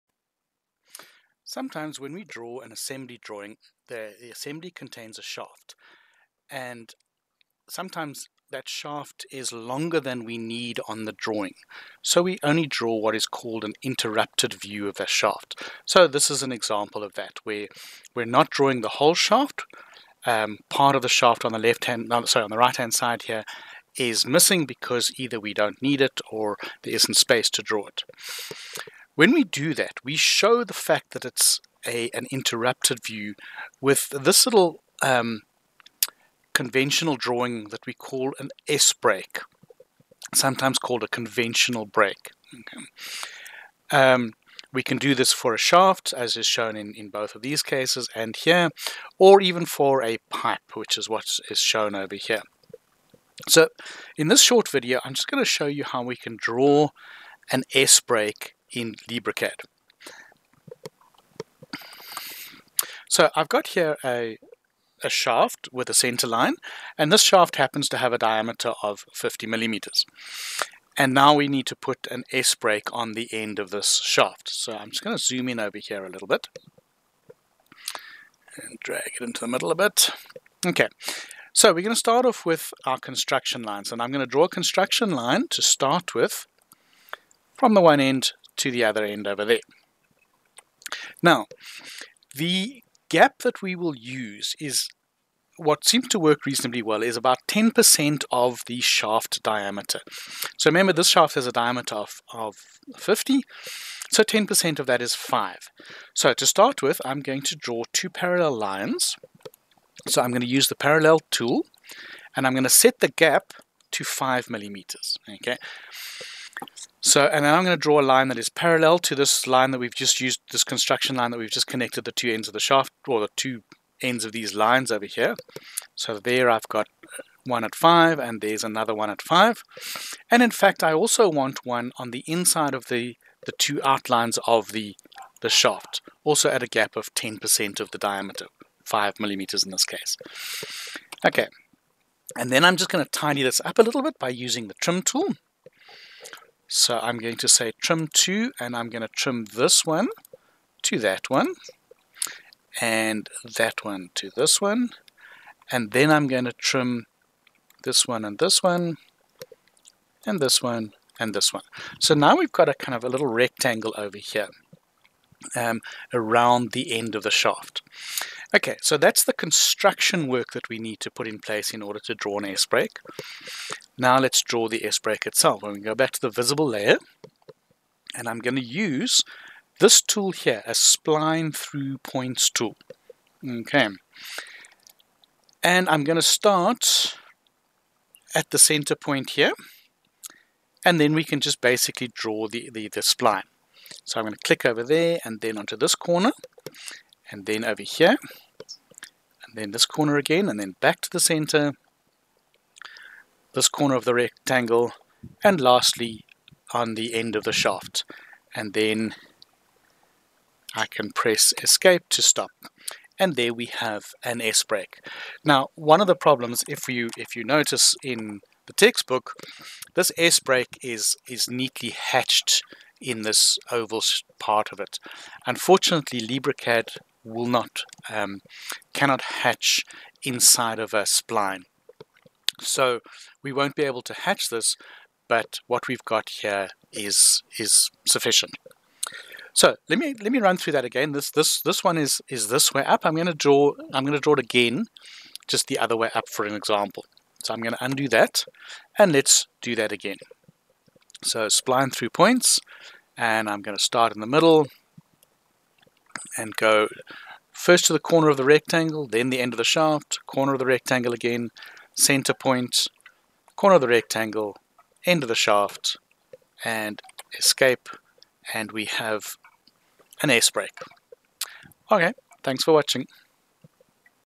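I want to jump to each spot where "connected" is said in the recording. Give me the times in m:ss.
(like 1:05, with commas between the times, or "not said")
2:01.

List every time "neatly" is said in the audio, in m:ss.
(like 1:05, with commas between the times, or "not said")
3:41.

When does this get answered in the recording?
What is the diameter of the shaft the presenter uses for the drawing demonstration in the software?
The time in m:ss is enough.
1:09.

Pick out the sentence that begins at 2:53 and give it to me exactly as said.
Now let's draw the S break itself.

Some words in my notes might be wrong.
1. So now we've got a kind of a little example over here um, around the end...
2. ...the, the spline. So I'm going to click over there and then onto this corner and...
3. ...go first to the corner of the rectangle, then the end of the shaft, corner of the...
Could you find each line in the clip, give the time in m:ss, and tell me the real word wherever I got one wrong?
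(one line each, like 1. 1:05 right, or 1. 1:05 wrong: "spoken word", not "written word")
1. 2:41 wrong: "rectangle", not "example"
2. 3:12 right
3. 4:16 right.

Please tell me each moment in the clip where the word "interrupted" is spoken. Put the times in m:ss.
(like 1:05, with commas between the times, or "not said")
0:13, 0:32.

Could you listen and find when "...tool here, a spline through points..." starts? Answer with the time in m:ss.
3:00.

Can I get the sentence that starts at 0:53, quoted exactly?
So in this short video, I'm just going to show you how we can draw an S break in LibreCAD.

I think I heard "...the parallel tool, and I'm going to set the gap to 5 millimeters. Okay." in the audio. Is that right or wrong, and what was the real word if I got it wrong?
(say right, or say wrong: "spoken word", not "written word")
right.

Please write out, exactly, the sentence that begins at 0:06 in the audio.
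And sometimes that shaft is longer than we need on the drawing.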